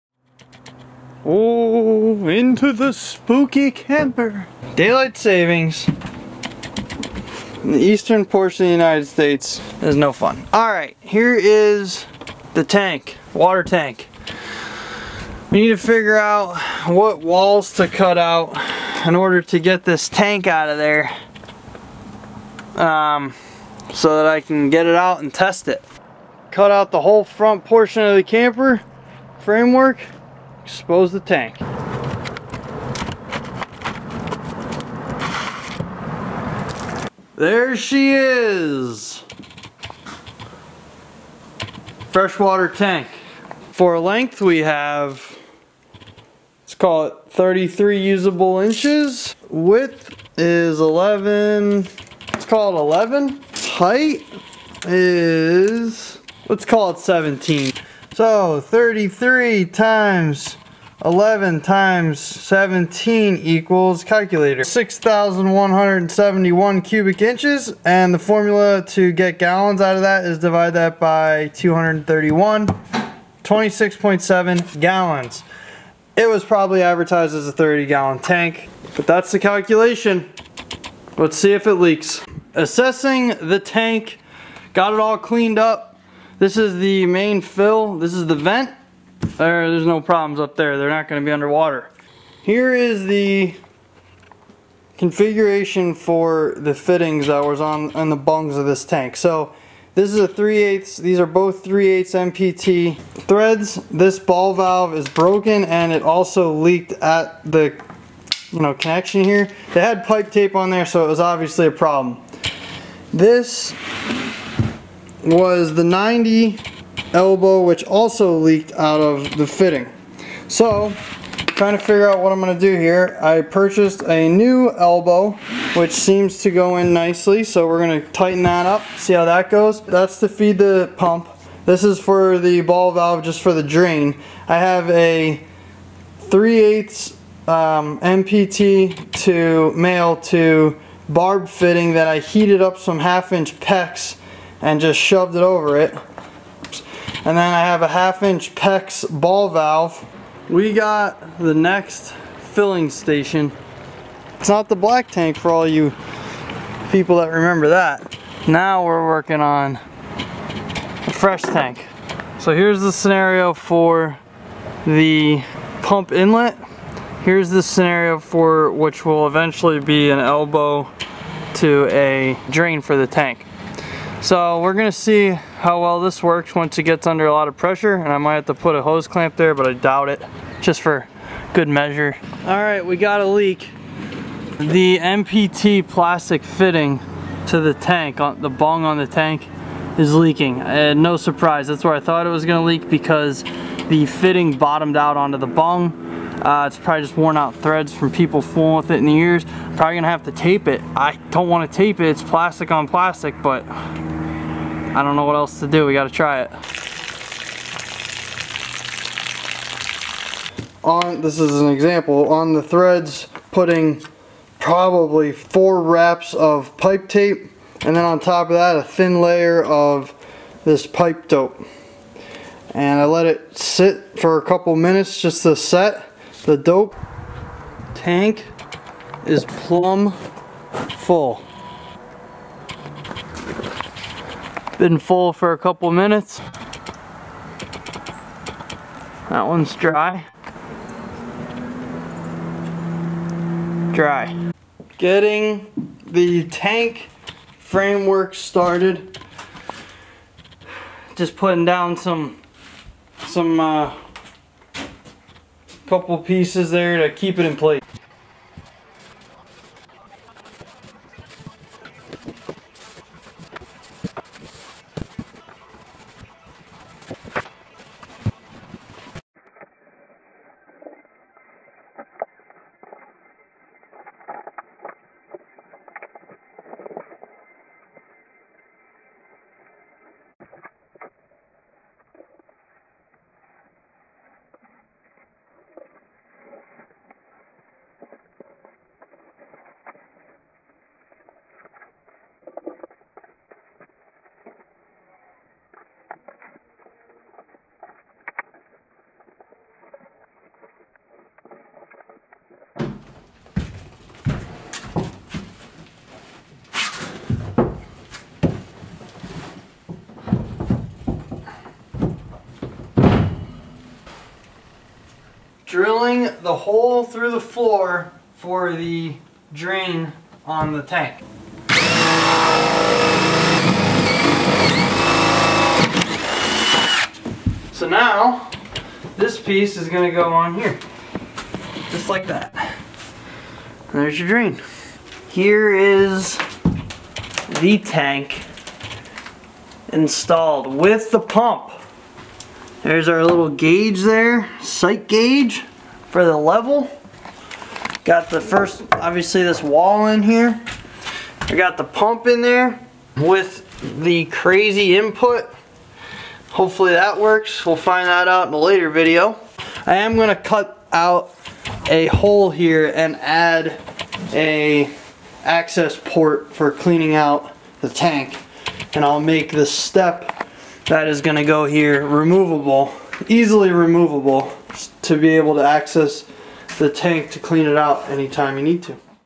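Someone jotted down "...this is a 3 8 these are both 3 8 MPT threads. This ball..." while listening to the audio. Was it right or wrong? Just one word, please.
right.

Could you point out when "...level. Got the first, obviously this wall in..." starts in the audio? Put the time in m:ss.
5:46.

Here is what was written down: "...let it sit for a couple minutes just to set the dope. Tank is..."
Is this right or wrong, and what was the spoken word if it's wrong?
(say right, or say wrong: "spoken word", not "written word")
right.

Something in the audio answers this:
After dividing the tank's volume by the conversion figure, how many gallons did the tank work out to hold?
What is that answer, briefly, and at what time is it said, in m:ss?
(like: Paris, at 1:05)
26.7 gallons, at 1:13.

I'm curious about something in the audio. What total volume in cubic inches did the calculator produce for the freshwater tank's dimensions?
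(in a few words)
6,171.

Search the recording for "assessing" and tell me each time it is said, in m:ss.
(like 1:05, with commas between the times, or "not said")
1:22.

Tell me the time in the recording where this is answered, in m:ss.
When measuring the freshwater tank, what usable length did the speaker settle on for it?
0:47.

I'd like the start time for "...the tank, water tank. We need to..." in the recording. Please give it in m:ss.
0:12.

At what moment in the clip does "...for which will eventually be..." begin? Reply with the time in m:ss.
2:48.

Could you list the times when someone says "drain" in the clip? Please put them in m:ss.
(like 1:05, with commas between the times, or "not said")
2:13, 2:52, 5:19, 5:34.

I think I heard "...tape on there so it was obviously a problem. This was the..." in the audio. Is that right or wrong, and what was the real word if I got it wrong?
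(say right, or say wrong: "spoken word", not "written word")
right.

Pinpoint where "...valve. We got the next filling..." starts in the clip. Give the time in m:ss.
2:29.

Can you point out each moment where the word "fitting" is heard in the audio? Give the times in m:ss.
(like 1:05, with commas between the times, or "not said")
1:36, 1:59, 2:21, 3:06, 3:14.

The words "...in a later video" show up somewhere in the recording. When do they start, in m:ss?
5:58.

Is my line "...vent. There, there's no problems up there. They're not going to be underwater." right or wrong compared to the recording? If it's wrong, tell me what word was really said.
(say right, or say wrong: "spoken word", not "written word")
right.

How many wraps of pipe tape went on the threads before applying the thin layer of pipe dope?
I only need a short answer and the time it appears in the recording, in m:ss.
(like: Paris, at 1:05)
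4, at 3:35.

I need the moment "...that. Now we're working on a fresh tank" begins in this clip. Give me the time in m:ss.
2:37.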